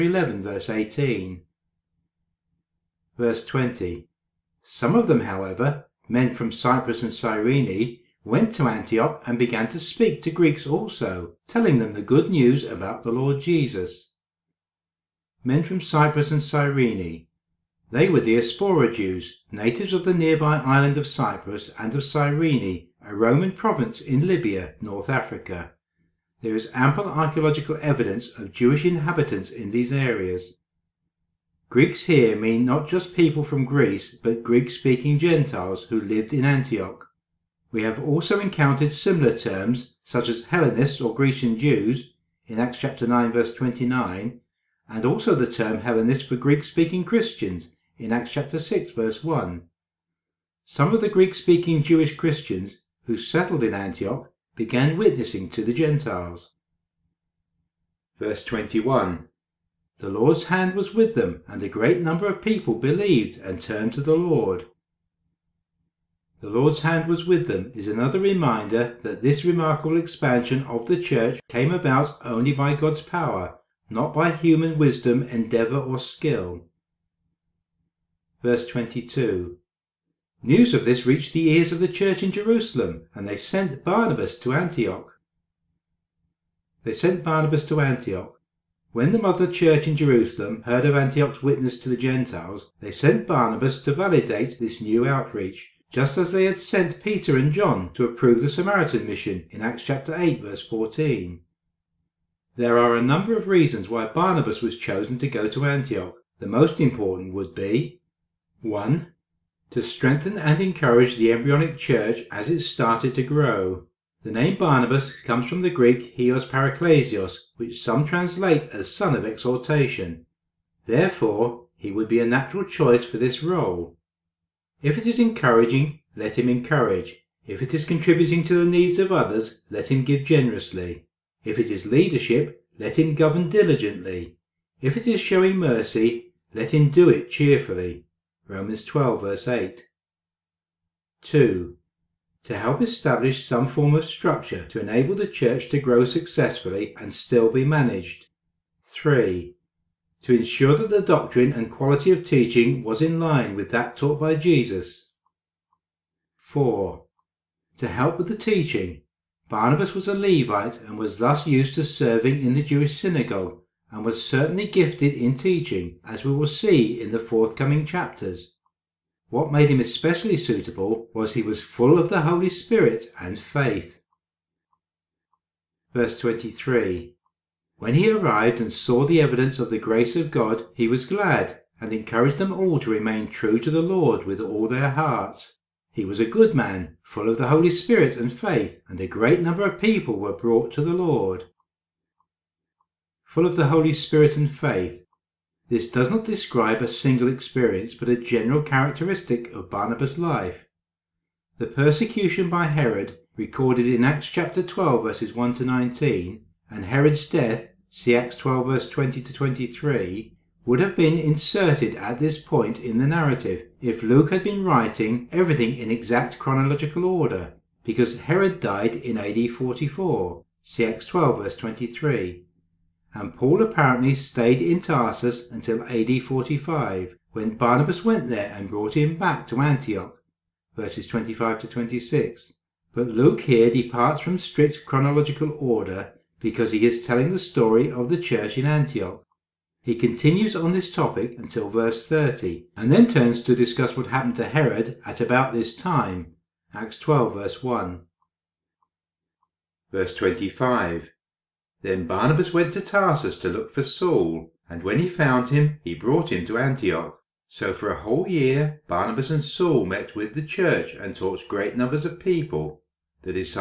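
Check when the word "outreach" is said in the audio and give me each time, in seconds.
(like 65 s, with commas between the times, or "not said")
95 s.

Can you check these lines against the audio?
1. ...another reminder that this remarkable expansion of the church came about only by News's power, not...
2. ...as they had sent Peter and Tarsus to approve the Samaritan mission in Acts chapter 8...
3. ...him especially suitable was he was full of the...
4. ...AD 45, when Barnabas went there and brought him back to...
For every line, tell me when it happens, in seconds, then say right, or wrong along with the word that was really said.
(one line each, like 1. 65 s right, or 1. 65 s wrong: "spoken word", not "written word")
1. 67 s wrong: "God", not "News"
2. 96 s wrong: "John", not "Tarsus"
3. 169 s right
4. 225 s right.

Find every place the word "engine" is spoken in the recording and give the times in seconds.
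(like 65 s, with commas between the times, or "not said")
not said.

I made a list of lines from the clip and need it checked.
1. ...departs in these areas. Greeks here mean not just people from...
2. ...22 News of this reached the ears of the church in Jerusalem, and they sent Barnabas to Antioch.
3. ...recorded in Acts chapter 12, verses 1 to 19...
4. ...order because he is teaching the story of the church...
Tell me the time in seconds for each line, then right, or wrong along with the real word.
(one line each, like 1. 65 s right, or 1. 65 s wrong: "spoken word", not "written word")
1. 28 s wrong: "inhabitants", not "departs"
2. 78 s right
3. 203 s right
4. 235 s wrong: "telling", not "teaching".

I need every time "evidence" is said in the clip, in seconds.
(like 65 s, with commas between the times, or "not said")
27 s, 179 s.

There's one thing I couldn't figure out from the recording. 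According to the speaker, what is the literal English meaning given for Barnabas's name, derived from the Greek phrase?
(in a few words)
Son of exhortation.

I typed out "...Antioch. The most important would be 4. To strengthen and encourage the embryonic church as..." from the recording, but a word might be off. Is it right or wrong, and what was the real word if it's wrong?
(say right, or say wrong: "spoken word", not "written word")
wrong: "1", not "4".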